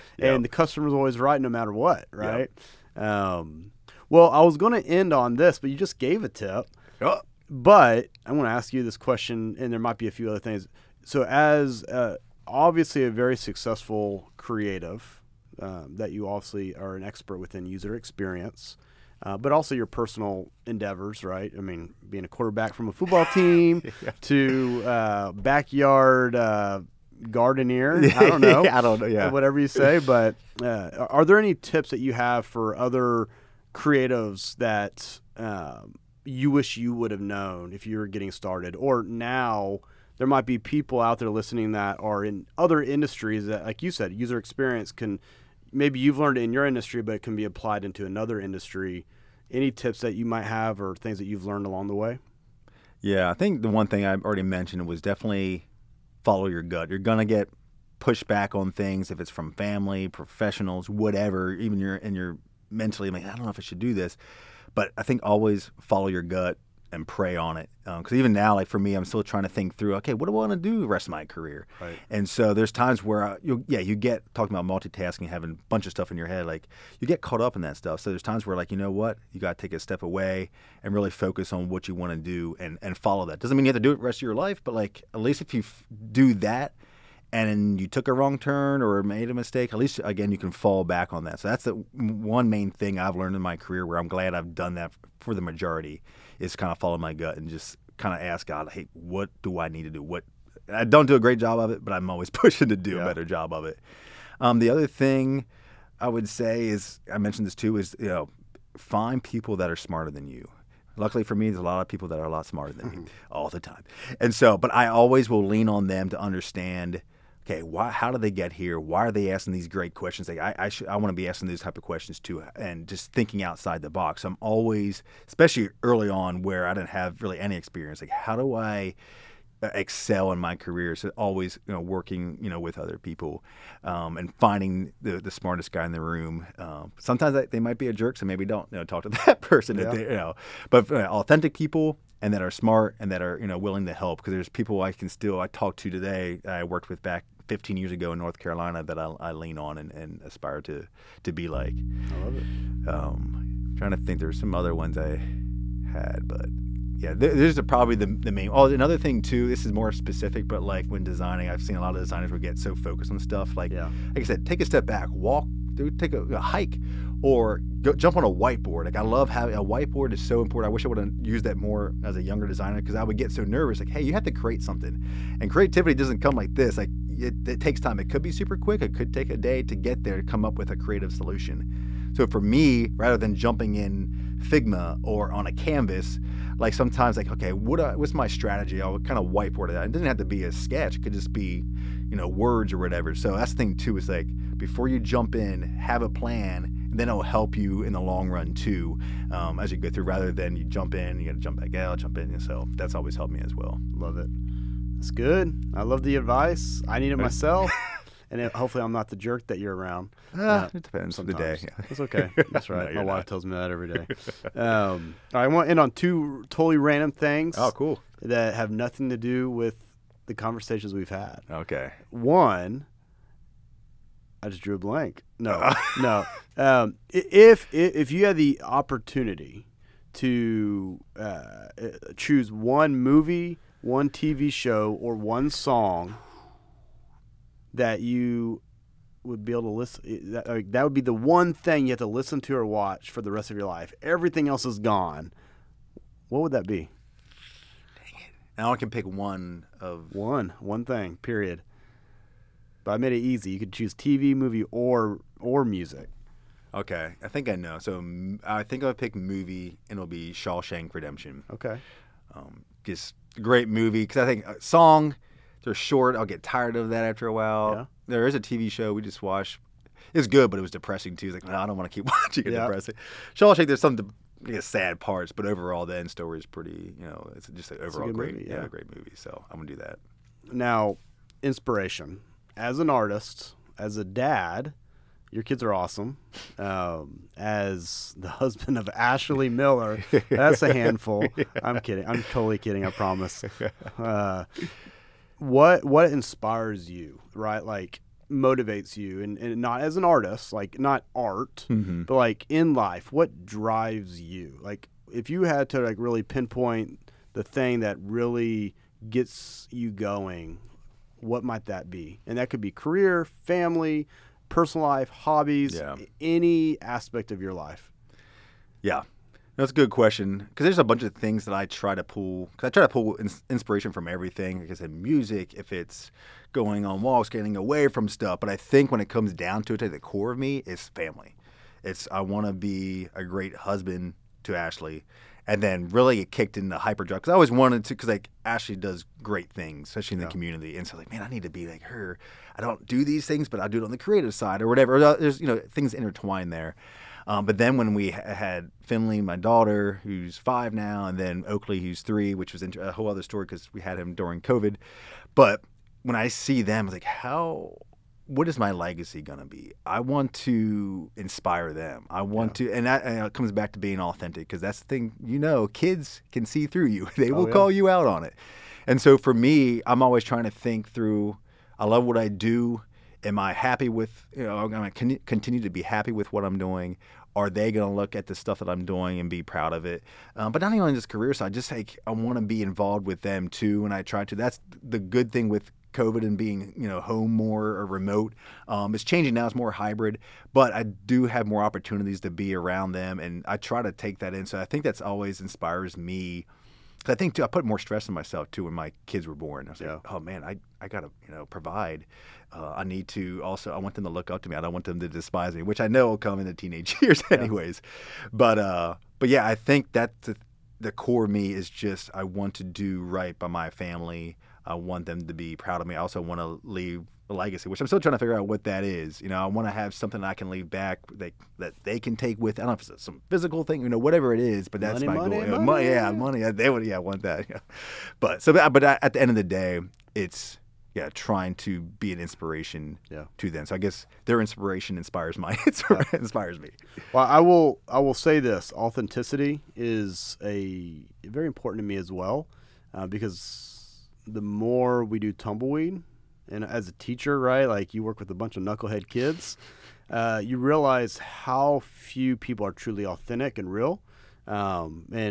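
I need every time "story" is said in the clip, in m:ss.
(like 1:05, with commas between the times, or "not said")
4:36, 5:53.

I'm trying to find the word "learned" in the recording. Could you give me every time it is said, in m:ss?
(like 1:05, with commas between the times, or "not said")
0:46, 0:51, 1:33.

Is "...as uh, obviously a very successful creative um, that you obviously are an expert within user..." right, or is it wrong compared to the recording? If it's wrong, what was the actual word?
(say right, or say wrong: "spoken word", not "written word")
right.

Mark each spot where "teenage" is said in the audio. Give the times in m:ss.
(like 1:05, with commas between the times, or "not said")
6:46.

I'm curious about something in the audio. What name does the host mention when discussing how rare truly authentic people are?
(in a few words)
Tumbleweed.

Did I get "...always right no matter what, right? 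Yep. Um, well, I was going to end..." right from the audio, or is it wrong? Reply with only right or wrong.
right.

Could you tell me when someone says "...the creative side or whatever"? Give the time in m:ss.
5:43.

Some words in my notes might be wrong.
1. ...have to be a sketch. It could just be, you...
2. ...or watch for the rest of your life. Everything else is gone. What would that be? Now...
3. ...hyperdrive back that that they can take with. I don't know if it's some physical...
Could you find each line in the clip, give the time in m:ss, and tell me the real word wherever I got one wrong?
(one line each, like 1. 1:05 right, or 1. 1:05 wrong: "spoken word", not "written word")
1. 3:10 right
2. 4:02 right
3. 7:00 wrong: "leave", not "hyperdrive".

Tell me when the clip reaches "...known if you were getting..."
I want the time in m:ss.
0:37.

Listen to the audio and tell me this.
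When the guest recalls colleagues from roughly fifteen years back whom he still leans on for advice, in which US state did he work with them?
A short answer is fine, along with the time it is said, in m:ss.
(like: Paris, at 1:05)
North Carolina, at 2:28.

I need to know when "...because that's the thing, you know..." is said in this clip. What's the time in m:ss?
6:04.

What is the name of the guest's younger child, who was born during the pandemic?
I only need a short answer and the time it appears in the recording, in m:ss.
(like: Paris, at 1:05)
Oakley, at 5:51.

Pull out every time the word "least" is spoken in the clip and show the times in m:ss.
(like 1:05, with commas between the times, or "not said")
1:25, 1:29.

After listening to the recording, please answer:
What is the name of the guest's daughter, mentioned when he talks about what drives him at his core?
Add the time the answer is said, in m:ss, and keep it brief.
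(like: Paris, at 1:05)
Finley, at 5:48.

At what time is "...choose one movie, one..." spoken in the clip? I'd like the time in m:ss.
3:52.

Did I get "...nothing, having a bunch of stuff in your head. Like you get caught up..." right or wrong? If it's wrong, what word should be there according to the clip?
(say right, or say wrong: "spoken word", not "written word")
wrong: "multitasking", not "nothing".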